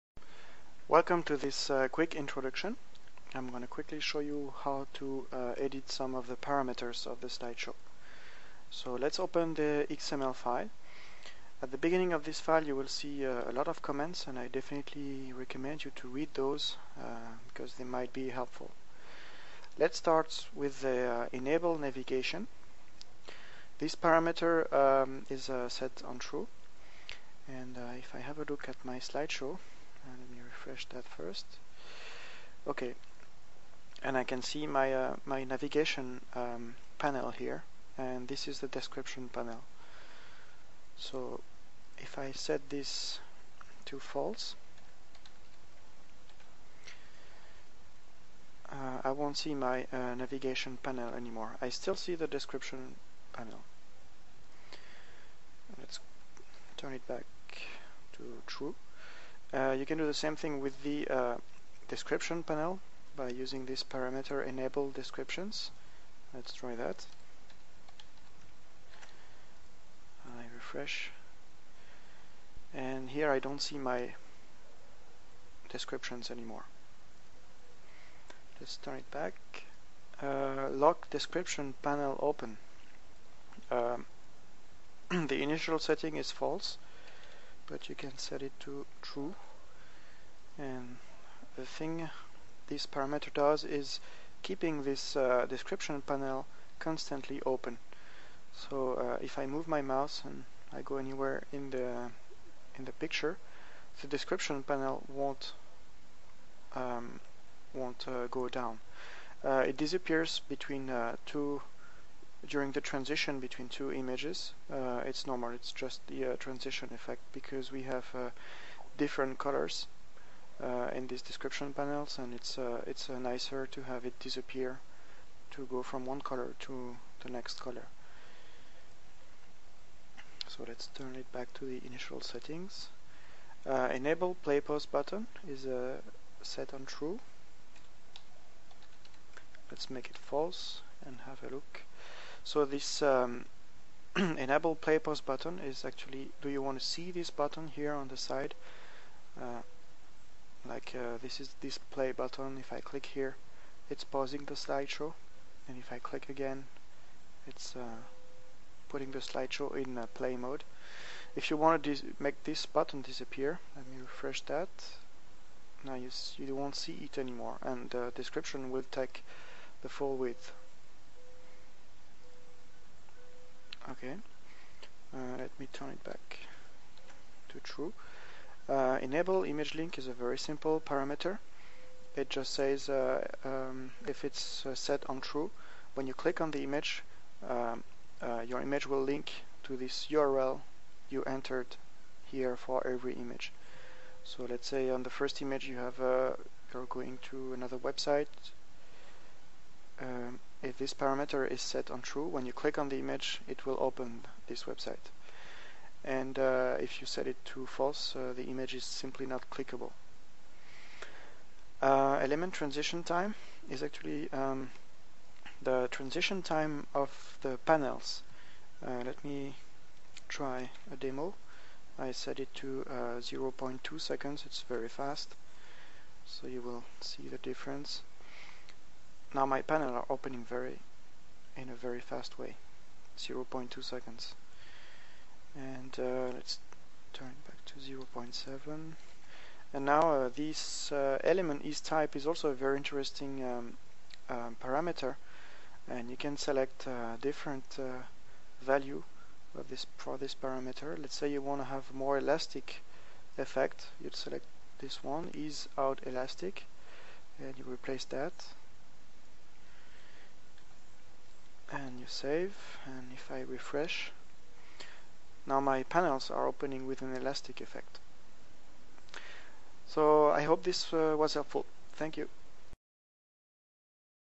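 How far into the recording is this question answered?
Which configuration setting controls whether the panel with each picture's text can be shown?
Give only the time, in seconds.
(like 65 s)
64 s.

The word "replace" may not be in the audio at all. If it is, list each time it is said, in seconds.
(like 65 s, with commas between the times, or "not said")
257 s.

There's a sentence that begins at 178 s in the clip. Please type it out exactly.
Uh, enable image link is a very simple parameter.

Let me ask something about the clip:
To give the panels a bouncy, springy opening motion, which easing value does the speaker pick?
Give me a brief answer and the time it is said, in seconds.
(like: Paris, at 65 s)
ease out elastic, at 255 s.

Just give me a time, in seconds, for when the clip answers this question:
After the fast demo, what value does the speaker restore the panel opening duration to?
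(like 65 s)
237 s.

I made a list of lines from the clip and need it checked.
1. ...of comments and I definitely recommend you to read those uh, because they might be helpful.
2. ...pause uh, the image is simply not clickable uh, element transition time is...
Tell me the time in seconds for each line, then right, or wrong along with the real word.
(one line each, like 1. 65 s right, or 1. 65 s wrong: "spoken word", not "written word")
1. 13 s right
2. 207 s wrong: "false", not "pause".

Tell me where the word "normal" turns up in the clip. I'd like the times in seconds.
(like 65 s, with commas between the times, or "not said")
115 s.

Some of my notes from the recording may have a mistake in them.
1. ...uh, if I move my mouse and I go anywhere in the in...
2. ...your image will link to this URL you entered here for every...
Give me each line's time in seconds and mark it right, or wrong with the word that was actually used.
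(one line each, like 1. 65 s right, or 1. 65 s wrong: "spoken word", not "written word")
1. 98 s right
2. 188 s right.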